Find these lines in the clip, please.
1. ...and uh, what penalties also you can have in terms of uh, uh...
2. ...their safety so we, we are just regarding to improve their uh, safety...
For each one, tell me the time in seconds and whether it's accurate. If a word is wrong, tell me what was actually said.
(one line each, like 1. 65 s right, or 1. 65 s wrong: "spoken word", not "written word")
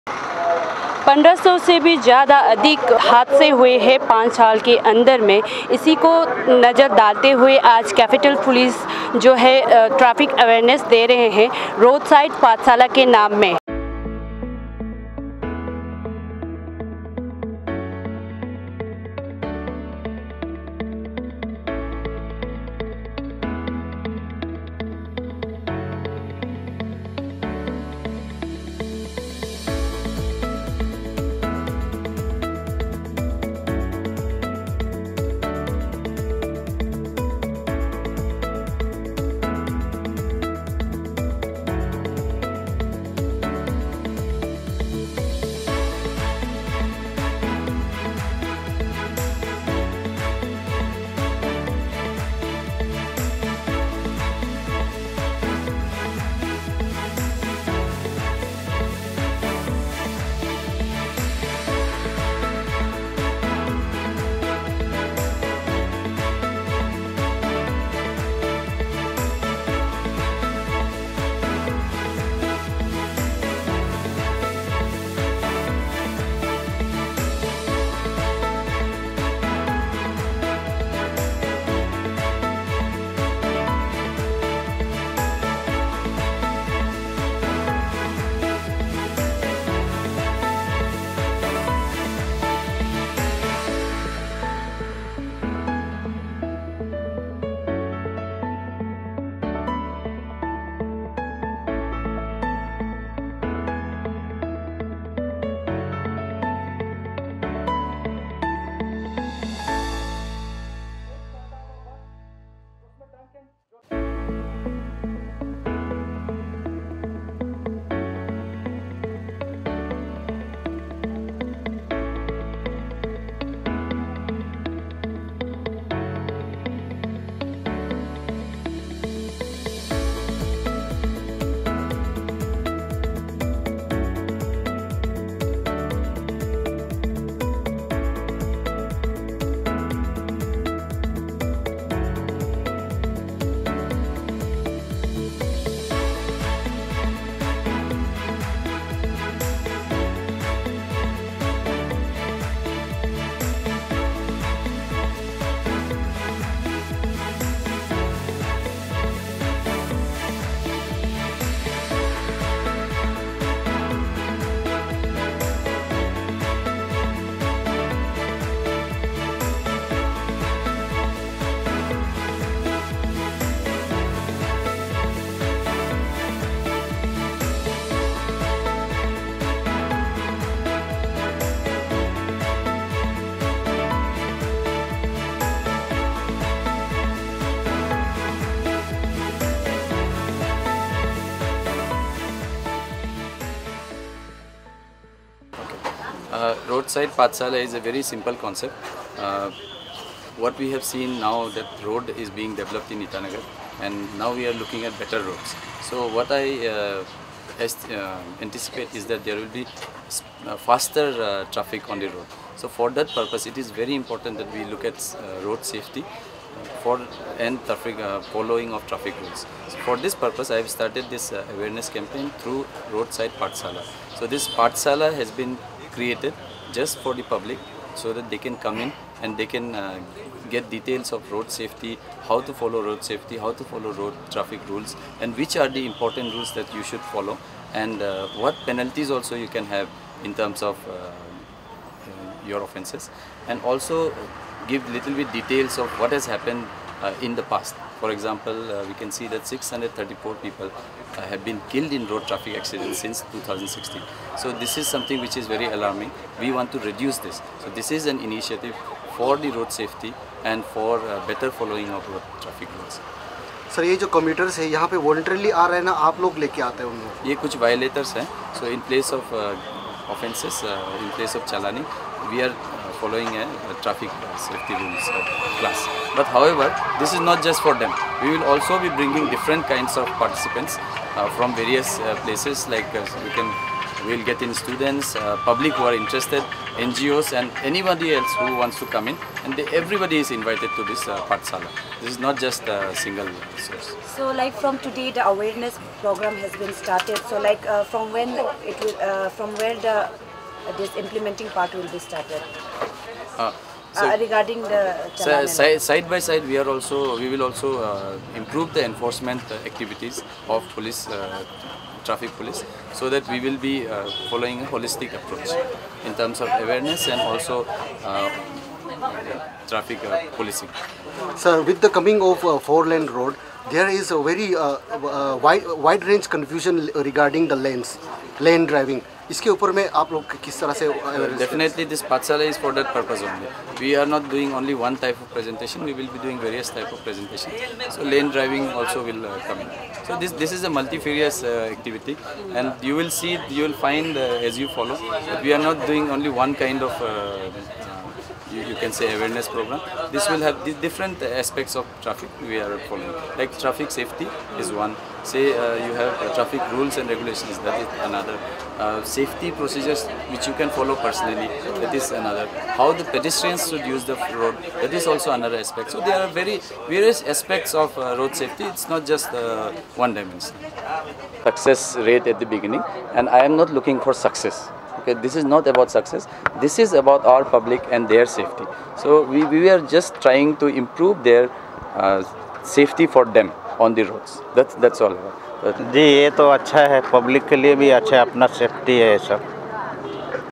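1. 237 s right
2. 378 s wrong: "trying", not "regarding".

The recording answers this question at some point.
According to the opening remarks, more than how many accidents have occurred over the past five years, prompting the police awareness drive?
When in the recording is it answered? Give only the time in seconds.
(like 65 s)
1 s.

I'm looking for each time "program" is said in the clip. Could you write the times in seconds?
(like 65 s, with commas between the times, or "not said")
296 s, 349 s.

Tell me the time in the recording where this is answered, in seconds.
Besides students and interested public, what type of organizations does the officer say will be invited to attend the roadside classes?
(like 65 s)
286 s.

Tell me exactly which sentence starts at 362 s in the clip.
How the pedestrians should use the road, that is also another aspect.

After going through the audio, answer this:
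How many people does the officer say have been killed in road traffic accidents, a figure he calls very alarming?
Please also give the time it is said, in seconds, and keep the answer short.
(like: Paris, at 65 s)
634, at 249 s.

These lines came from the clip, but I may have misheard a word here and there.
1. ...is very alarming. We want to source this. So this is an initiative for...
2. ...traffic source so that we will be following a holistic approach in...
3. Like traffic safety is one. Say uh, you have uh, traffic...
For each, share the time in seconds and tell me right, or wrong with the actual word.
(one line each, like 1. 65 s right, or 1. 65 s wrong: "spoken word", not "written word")
1. 255 s wrong: "reduce", not "source"
2. 312 s wrong: "police", not "source"
3. 353 s right.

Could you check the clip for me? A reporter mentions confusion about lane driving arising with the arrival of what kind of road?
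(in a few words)
four lane road.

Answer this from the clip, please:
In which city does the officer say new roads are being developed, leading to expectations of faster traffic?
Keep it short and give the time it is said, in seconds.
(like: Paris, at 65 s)
Itanagar, at 203 s.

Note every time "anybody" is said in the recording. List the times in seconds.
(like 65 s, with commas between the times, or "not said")
287 s.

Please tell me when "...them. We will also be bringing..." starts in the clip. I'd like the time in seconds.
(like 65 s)
277 s.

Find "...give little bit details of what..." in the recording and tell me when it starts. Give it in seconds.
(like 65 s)
244 s.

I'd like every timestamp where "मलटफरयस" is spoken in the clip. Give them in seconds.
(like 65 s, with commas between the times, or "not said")
340 s.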